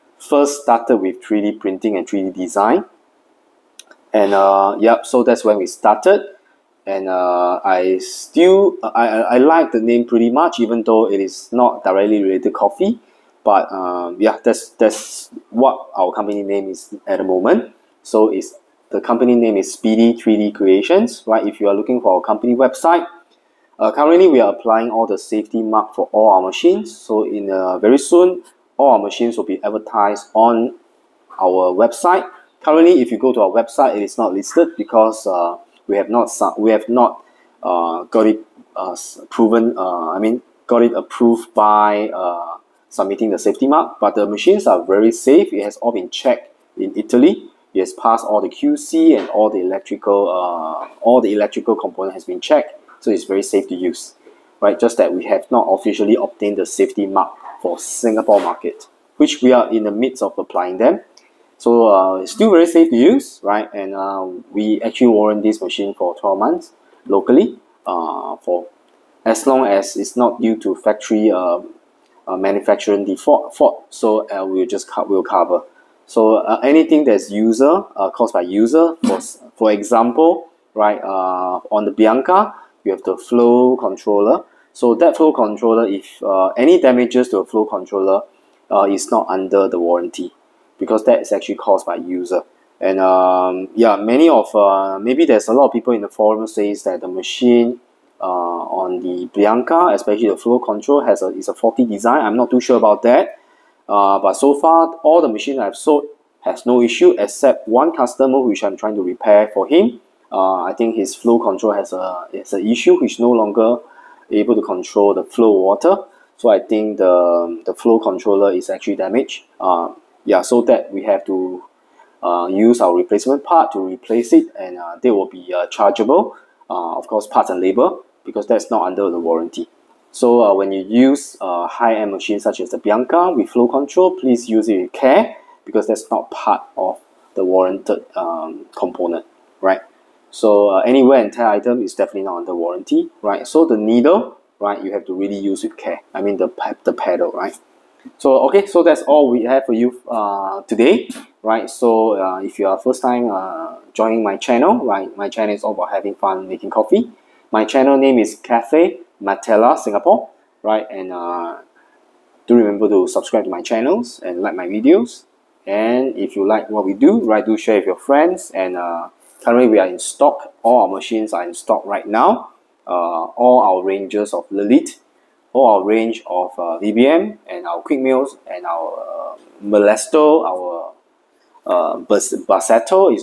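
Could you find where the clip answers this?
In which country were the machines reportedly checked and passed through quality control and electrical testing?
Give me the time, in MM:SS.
00:46.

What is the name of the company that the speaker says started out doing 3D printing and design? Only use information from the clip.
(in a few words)
Speedy 3D Creations.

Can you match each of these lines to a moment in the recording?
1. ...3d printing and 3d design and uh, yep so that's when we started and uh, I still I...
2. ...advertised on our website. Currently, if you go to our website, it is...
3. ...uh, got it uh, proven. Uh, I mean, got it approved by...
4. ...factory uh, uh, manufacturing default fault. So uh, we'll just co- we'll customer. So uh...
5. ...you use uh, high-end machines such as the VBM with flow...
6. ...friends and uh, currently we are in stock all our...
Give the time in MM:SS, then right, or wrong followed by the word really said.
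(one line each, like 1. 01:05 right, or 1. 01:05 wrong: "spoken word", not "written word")
1. 00:01 right
2. 00:29 right
3. 00:37 right
4. 01:10 wrong: "cover", not "customer"
5. 02:10 wrong: "Bianca", not "VBM"
6. 02:47 right.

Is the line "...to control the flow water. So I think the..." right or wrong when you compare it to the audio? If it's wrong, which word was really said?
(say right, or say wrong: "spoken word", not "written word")
right.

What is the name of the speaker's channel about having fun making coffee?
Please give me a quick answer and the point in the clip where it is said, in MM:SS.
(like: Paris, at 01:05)
Cafe Matella Singapore, at 02:38.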